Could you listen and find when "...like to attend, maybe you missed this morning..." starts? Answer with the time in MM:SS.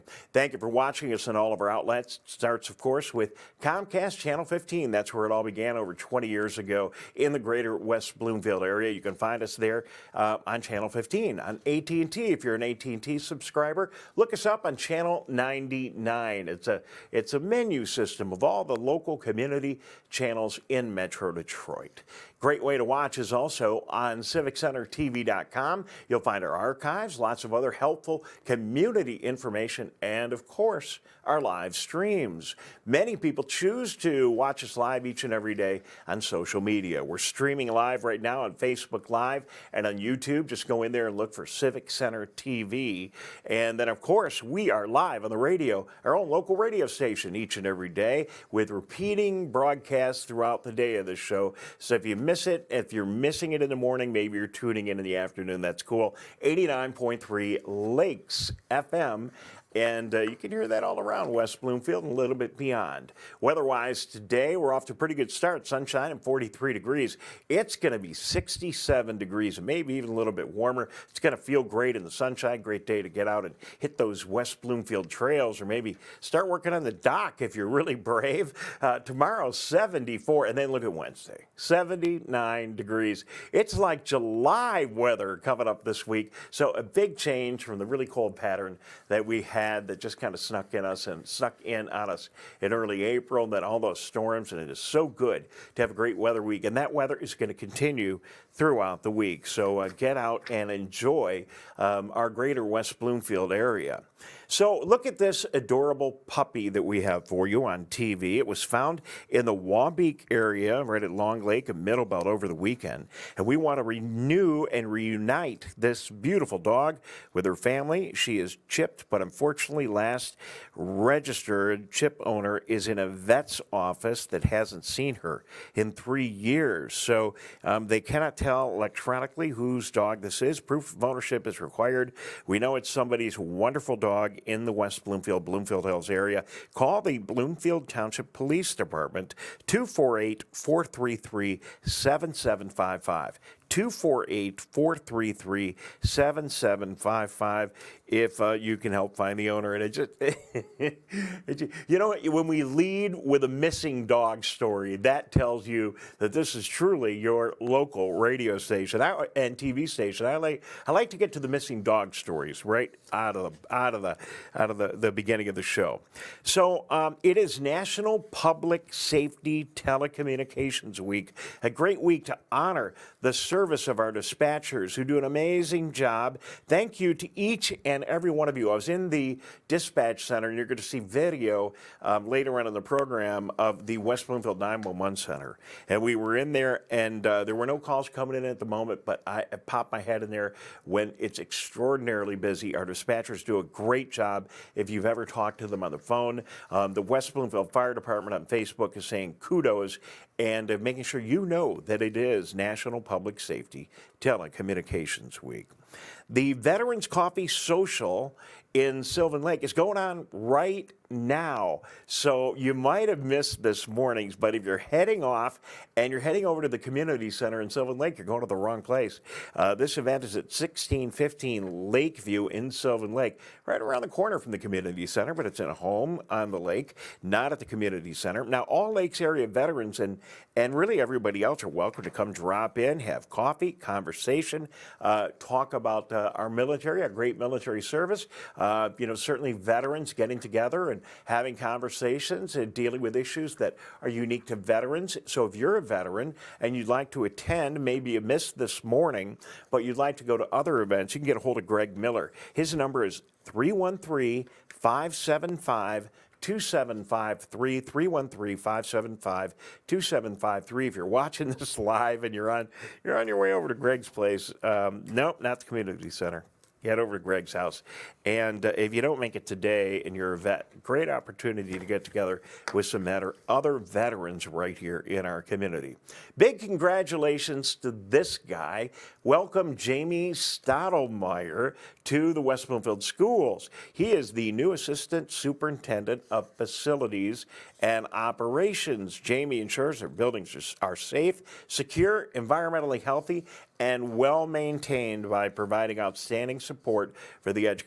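04:06.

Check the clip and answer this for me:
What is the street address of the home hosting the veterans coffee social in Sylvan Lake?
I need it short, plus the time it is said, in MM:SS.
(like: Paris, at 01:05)
1615 Lakeview, at 03:40.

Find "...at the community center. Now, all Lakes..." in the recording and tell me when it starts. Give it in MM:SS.
03:47.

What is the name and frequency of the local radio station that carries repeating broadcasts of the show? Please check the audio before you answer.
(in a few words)
89.3 Lakes FM.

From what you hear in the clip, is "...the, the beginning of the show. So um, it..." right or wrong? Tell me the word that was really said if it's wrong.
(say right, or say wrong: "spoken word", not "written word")
right.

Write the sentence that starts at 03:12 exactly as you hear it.
Our dispatchers do a great job.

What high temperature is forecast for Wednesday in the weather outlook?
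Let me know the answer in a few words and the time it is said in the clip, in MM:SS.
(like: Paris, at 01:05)
79 degrees, at 01:21.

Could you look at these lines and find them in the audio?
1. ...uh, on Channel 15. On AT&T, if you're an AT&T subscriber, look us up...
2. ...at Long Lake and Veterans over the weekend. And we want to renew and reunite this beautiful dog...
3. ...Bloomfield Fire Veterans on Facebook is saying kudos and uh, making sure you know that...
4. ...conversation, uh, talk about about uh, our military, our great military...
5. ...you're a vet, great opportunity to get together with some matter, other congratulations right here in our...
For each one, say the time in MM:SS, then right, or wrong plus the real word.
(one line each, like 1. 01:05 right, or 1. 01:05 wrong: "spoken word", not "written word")
1. 00:10 right
2. 01:51 wrong: "Middlebelt", not "Veterans"
3. 03:17 wrong: "Department", not "Veterans"
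4. 03:53 right
5. 04:30 wrong: "veterans", not "congratulations".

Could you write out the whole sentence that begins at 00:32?
Many people choose to watch us live each and every day on social media.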